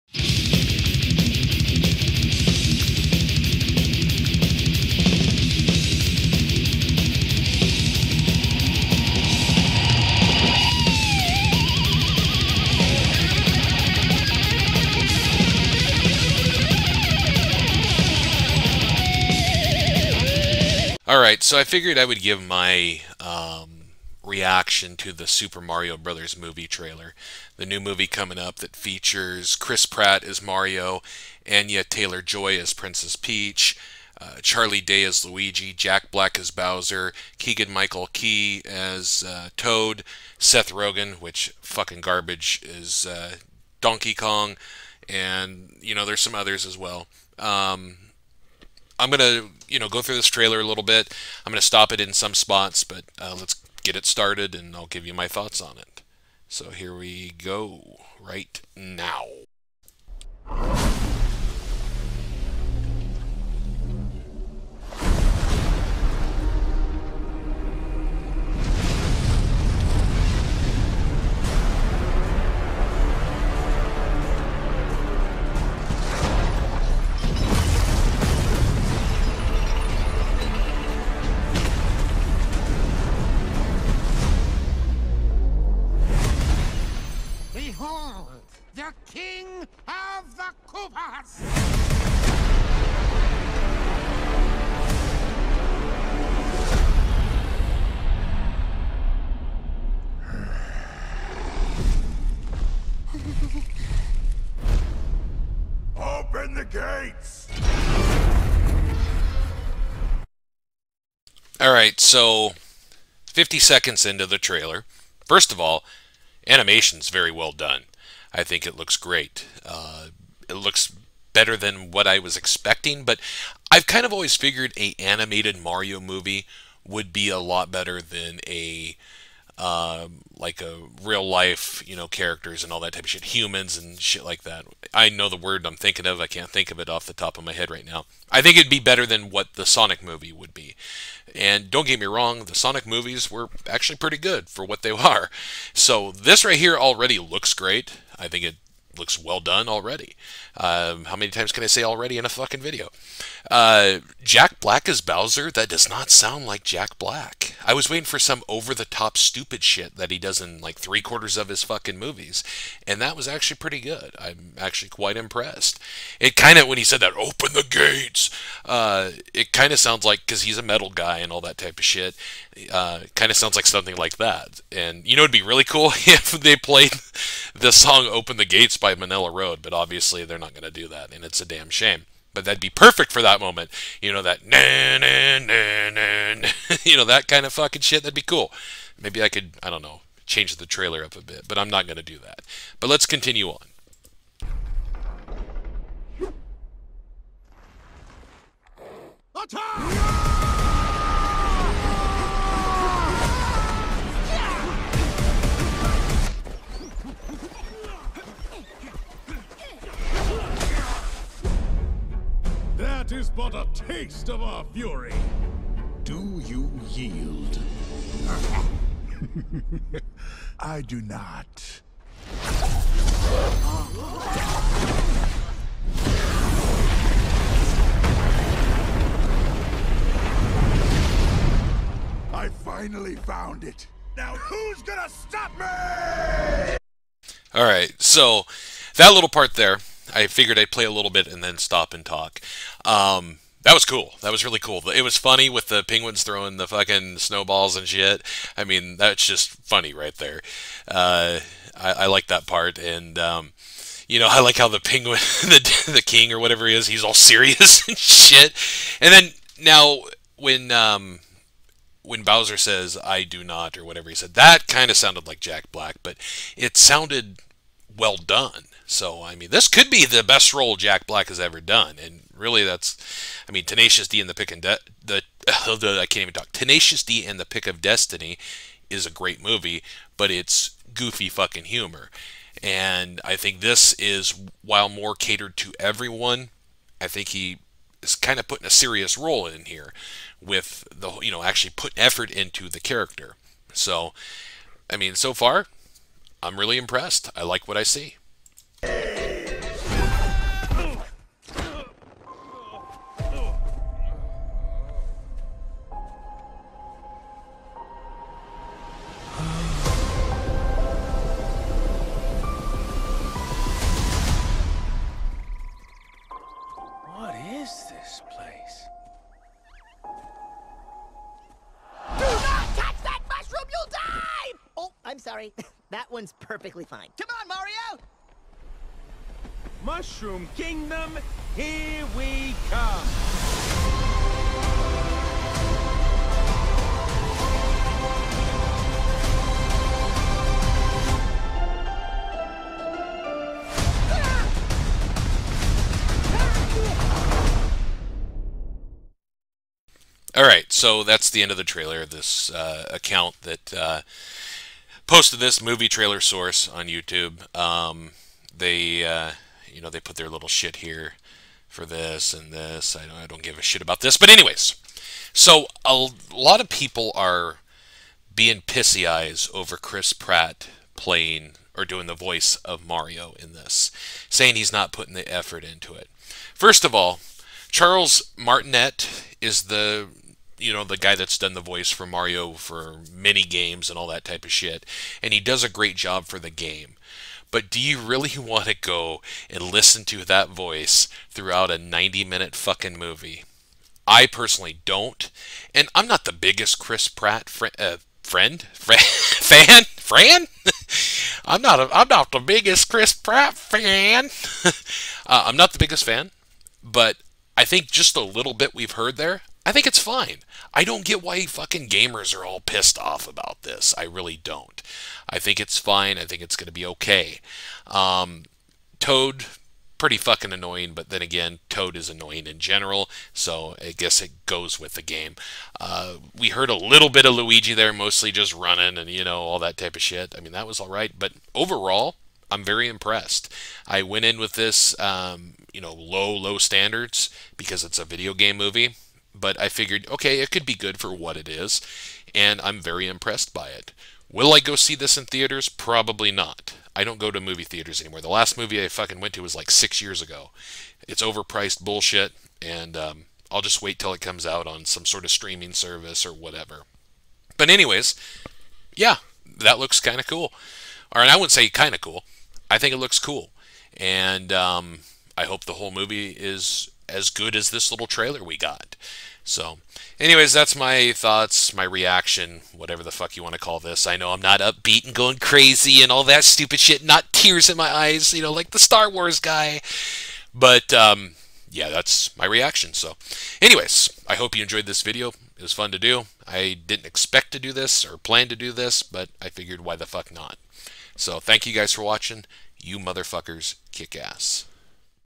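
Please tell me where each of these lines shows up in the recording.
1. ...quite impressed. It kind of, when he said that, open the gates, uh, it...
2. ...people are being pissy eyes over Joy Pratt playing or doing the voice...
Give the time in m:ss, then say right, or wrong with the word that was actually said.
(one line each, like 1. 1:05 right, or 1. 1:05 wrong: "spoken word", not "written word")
1. 2:44 right
2. 6:06 wrong: "Chris", not "Joy".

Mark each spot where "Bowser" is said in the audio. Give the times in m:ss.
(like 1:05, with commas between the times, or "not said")
0:36, 2:35, 4:22.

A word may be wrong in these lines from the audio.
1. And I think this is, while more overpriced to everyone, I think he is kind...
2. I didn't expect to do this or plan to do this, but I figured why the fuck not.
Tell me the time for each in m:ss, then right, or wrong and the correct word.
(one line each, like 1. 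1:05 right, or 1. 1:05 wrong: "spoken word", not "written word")
1. 4:42 wrong: "catered", not "overpriced"
2. 8:06 right.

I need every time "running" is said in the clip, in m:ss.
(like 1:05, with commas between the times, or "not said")
7:08.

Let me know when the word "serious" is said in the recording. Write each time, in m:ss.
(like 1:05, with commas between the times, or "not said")
4:17, 4:48.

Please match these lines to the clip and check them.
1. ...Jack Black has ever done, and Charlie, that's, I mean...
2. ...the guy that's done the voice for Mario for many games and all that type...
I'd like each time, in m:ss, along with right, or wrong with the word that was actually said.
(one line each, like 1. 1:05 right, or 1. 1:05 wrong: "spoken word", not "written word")
1. 4:30 wrong: "Really", not "Charlie"
2. 6:20 right.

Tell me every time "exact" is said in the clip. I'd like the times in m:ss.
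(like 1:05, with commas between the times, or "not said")
not said.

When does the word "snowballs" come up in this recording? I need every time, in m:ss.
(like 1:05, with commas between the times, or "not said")
4:07.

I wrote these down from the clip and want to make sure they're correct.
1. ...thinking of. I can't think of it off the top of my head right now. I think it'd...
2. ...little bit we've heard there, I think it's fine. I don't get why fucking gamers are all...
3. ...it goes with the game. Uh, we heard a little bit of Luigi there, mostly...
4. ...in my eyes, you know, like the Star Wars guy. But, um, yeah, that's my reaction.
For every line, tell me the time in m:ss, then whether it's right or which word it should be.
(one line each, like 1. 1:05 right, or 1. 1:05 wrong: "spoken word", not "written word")
1. 2:15 right
2. 6:48 right
3. 7:04 right
4. 7:57 right.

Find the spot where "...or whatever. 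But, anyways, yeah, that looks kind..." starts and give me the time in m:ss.
7:36.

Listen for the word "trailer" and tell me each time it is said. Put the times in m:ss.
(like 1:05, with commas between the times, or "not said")
0:26, 0:50, 1:54, 3:10, 5:51, 5:55, 7:48.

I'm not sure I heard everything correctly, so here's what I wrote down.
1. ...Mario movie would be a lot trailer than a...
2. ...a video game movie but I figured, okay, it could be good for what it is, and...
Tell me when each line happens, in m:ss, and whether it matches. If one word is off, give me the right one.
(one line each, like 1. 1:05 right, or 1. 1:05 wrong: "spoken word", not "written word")
1. 2:05 wrong: "better", not "trailer"
2. 7:17 right.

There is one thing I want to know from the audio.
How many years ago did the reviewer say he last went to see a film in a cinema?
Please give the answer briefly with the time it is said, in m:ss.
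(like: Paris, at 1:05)
6 years, at 7:29.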